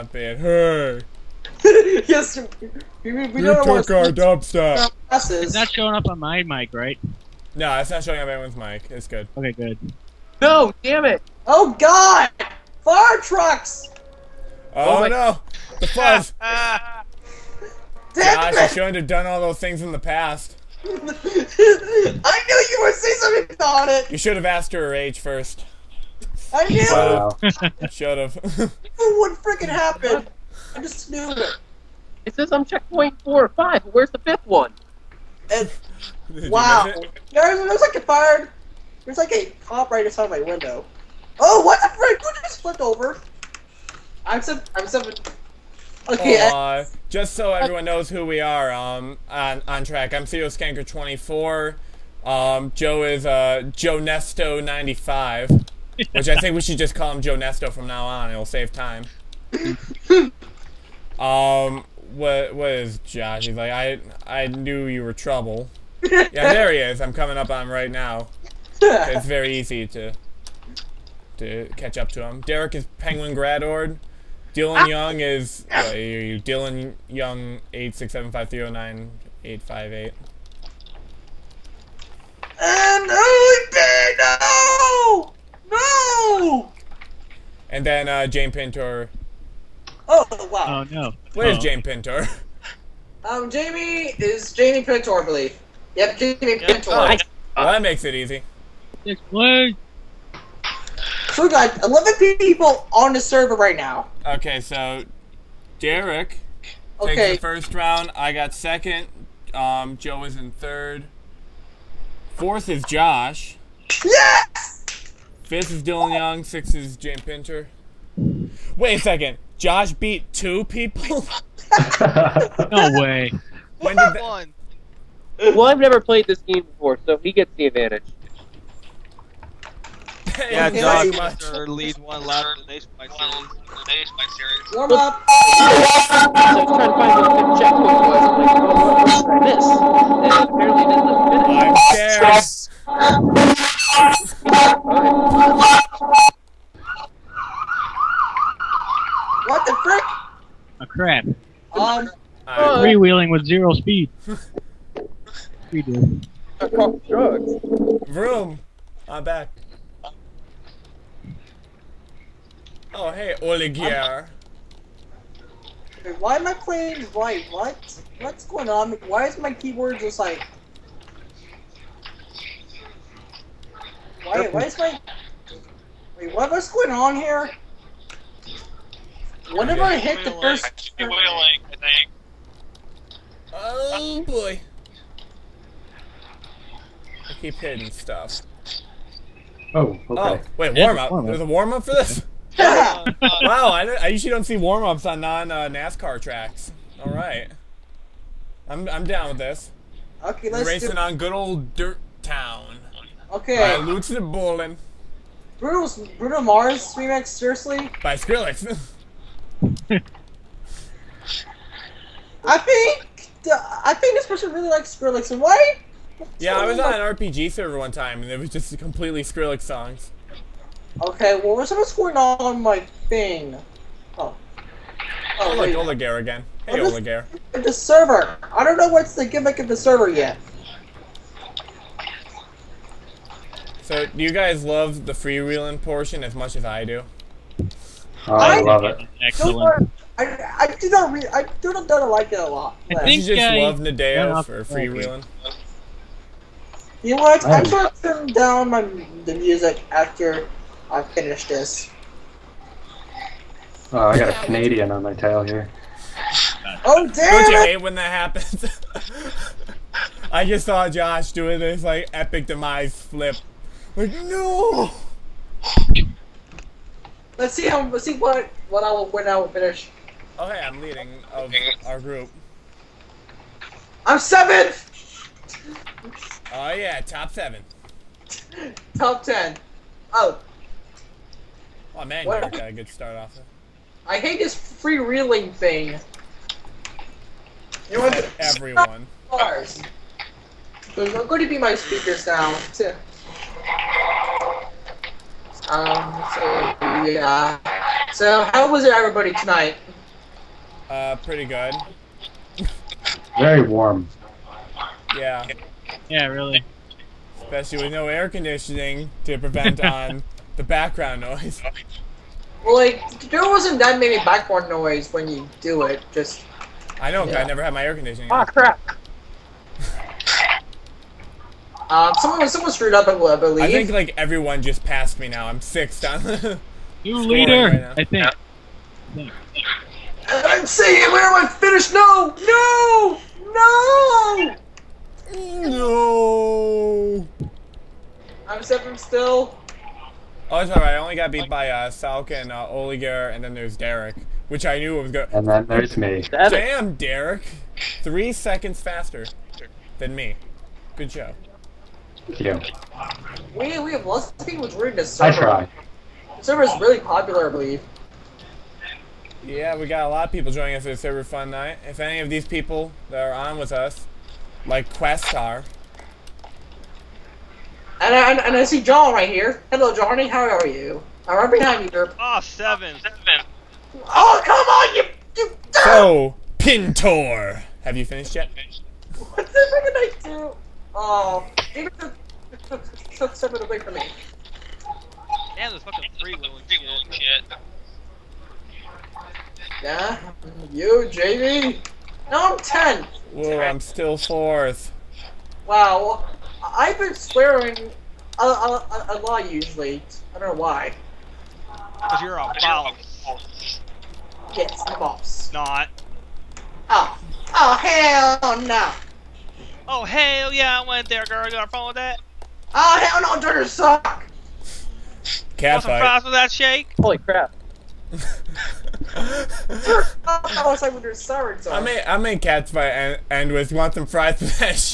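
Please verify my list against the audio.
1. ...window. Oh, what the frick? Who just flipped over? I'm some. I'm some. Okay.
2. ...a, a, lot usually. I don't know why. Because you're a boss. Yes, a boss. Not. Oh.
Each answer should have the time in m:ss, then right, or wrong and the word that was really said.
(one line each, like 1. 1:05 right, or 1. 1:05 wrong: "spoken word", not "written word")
1. 0:40 right
2. 6:38 right.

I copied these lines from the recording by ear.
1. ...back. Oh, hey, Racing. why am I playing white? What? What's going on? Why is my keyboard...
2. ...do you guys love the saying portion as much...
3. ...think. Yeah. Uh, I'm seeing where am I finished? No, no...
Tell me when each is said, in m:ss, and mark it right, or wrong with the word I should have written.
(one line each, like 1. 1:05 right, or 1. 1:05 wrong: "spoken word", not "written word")
1. 2:39 wrong: "Oligier", not "Racing"
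2. 3:54 wrong: "freewheeling", not "saying"
3. 5:28 right.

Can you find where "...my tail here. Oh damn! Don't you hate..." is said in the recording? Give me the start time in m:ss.
4:15.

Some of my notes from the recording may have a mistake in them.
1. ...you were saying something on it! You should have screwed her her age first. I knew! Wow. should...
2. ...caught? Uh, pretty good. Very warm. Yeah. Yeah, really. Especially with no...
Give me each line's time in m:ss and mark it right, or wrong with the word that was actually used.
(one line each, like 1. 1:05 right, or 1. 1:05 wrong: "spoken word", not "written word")
1. 0:21 wrong: "asked", not "screwed"
2. 4:59 wrong: "tonight", not "caught".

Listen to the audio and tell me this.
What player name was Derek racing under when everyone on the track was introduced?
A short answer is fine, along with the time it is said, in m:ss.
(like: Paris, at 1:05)
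Penguin Gradord, at 1:12.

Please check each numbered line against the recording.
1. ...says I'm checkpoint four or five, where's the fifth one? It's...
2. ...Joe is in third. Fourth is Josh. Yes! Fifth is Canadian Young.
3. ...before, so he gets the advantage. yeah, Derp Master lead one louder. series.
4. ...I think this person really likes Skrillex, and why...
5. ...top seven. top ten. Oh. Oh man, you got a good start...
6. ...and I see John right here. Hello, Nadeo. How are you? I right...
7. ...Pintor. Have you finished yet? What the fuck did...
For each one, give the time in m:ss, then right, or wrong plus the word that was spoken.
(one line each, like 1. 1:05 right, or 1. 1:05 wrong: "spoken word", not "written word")
1. 0:32 right
2. 1:49 wrong: "Dillon", not "Canadian"
3. 2:06 wrong: "Dog", not "Derp"
4. 3:33 right
5. 4:37 right
6. 6:08 wrong: "Johnny", not "Nadeo"
7. 6:16 right.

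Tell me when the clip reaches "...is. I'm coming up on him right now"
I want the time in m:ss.
1:06.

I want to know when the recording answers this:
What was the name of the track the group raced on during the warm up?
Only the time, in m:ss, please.
3:21.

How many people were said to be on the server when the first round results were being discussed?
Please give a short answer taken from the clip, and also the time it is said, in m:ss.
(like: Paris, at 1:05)
11, at 1:41.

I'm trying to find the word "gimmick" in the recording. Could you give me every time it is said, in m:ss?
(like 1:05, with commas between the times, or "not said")
3:49.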